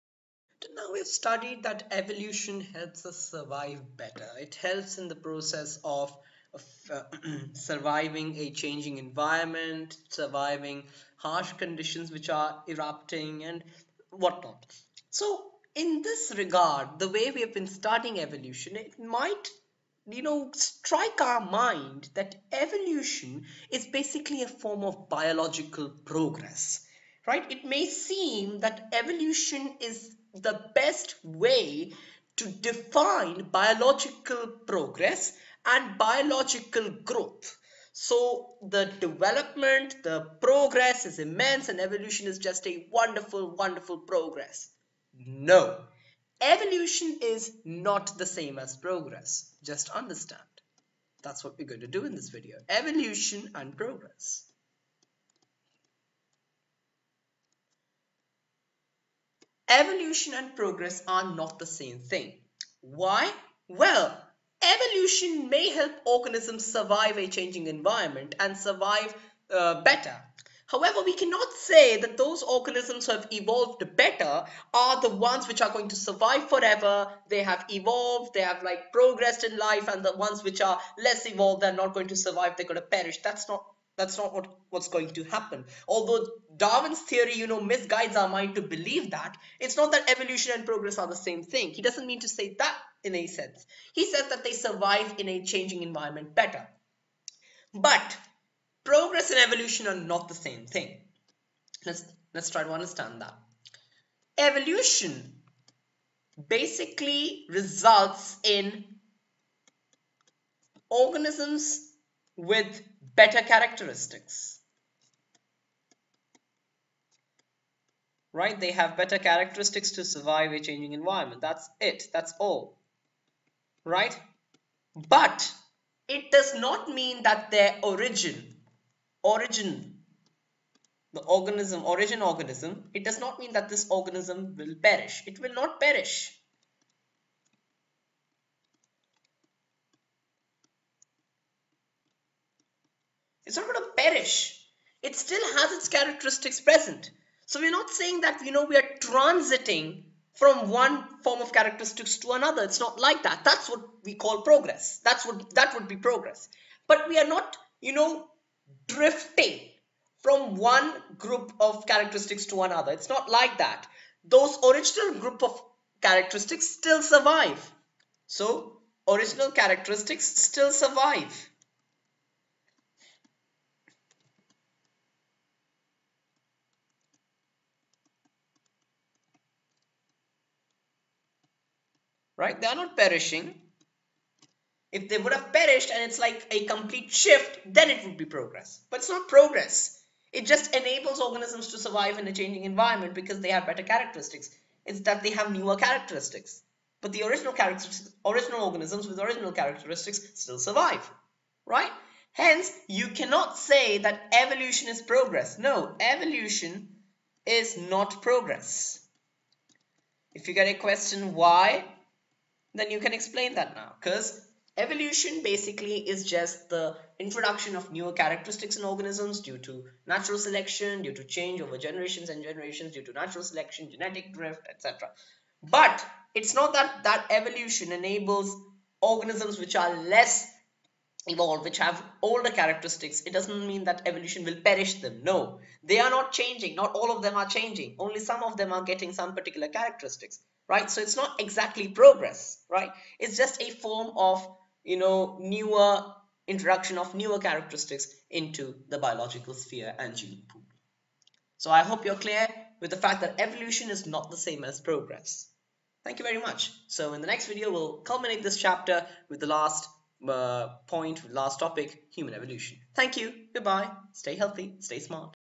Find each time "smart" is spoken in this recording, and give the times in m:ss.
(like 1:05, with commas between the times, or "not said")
4:24.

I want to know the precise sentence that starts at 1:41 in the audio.
Let's, let's try to understand that.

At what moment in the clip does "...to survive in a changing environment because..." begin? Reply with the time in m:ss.
3:11.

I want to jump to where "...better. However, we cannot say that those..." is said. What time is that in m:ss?
1:09.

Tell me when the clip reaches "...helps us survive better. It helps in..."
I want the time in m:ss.
0:02.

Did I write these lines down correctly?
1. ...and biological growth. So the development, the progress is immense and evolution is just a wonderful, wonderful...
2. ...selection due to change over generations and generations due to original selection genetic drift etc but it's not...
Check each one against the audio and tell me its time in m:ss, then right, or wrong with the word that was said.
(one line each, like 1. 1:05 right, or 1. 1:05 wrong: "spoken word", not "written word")
1. 0:35 right
2. 3:40 wrong: "natural", not "original".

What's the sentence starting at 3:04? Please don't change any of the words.
If they would have perished and it's like a complete shift, then it would be progress.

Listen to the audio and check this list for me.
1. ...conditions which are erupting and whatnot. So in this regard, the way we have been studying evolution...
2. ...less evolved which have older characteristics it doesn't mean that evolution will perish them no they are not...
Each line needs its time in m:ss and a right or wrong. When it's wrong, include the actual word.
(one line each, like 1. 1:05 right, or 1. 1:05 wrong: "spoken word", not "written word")
1. 0:11 right
2. 3:50 right.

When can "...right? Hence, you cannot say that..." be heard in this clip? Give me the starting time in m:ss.
3:21.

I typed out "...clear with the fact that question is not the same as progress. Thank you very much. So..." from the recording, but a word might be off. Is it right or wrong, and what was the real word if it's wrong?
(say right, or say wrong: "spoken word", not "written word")
wrong: "evolution", not "question".